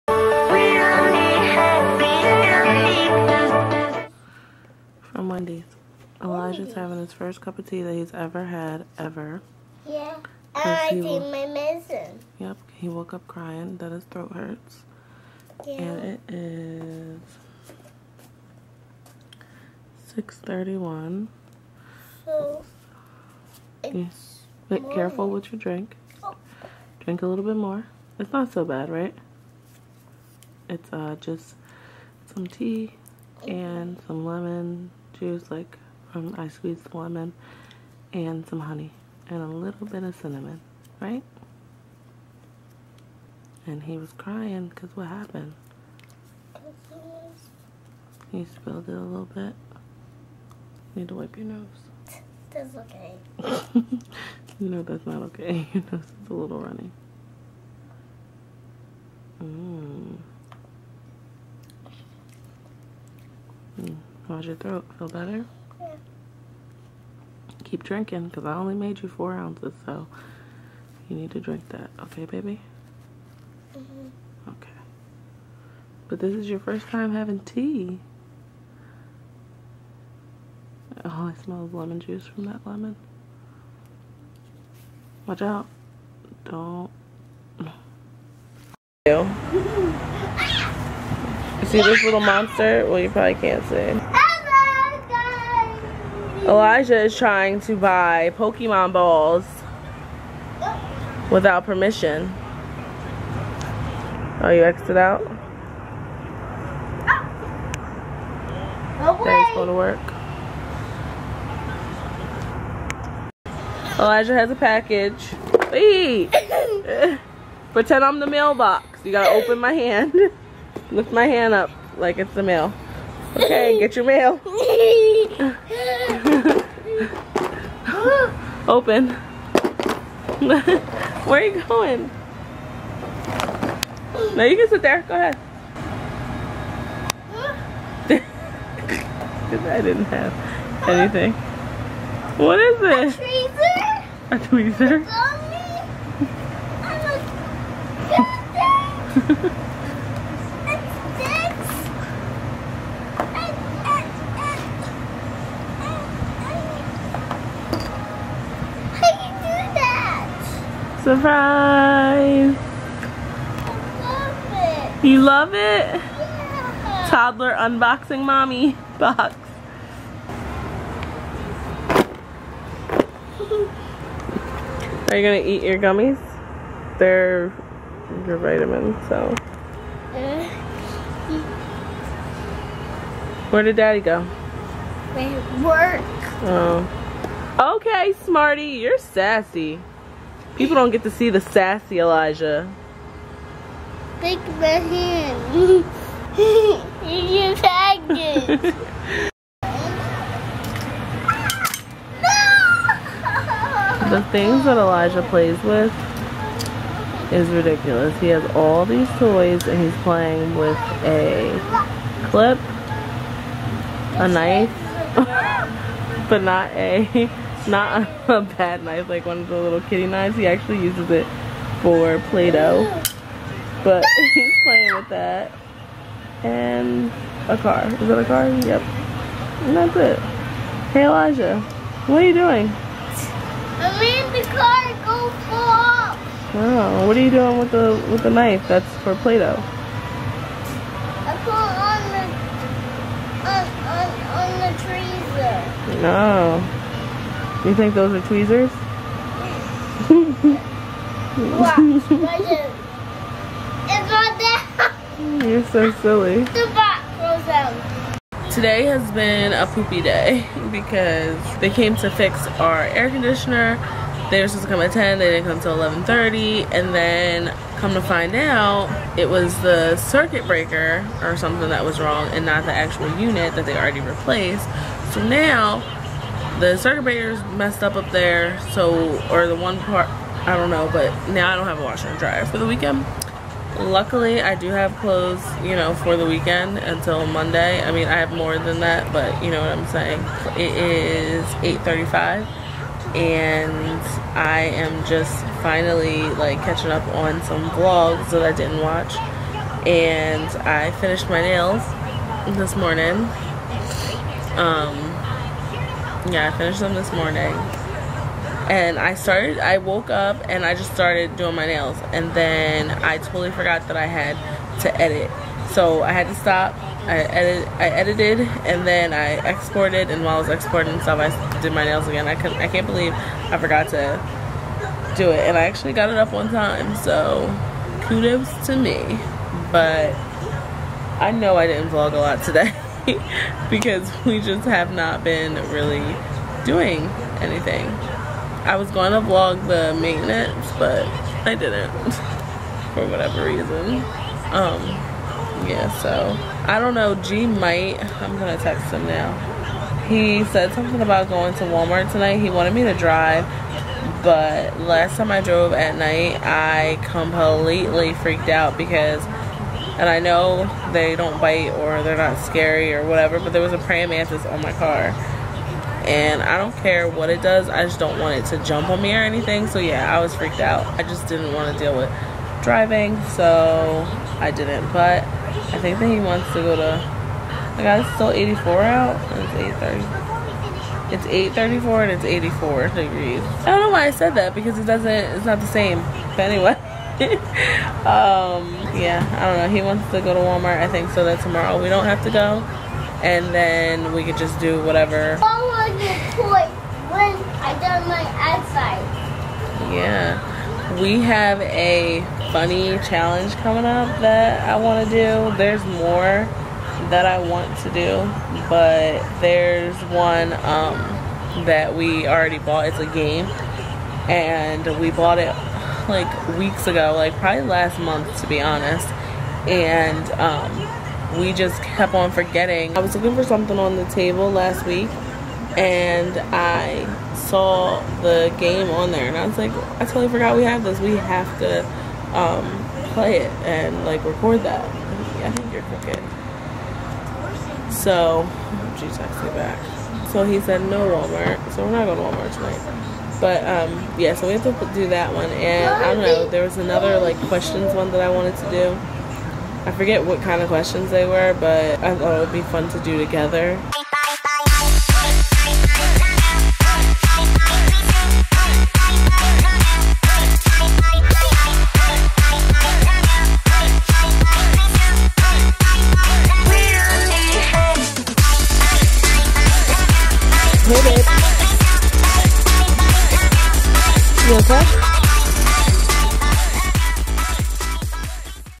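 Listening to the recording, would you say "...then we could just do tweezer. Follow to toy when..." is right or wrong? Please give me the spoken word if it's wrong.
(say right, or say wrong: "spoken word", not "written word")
wrong: "whatever", not "tweezer".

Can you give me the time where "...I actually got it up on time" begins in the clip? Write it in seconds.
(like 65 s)
325 s.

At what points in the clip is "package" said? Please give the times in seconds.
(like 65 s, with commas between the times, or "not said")
114 s, 197 s.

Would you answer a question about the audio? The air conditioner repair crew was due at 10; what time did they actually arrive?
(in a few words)
11:30.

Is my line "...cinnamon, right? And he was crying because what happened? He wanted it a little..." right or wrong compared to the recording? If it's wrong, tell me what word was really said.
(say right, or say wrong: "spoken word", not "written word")
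wrong: "spilled", not "wanted".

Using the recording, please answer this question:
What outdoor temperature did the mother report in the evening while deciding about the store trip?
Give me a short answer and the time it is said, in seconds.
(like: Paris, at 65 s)
84 degrees, at 382 s.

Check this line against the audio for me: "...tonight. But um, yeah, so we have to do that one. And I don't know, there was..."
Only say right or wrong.
right.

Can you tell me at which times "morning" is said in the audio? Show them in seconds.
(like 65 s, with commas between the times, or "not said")
302 s, 307 s.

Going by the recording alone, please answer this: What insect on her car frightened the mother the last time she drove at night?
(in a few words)
praying mantis.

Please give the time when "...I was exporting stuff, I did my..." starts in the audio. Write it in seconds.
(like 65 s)
320 s.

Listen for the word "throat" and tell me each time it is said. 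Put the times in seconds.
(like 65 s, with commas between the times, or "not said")
14 s, 64 s.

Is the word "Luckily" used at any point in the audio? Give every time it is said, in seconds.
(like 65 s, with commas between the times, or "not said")
283 s.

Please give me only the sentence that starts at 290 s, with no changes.
It is 8.35 and I am just finally like catching up on some vlogs that I didn't watch.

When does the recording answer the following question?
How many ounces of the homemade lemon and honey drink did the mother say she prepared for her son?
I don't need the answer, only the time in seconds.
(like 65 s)
69 s.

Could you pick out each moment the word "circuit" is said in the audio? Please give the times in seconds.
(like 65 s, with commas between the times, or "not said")
269 s, 276 s.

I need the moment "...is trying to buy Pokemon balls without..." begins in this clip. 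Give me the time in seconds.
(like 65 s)
97 s.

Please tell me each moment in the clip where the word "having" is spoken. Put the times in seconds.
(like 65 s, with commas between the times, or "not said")
6 s, 77 s.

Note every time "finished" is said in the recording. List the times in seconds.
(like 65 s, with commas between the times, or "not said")
301 s, 306 s.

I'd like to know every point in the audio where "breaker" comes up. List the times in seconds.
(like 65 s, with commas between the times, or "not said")
270 s, 277 s.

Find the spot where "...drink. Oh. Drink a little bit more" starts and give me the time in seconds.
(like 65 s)
25 s.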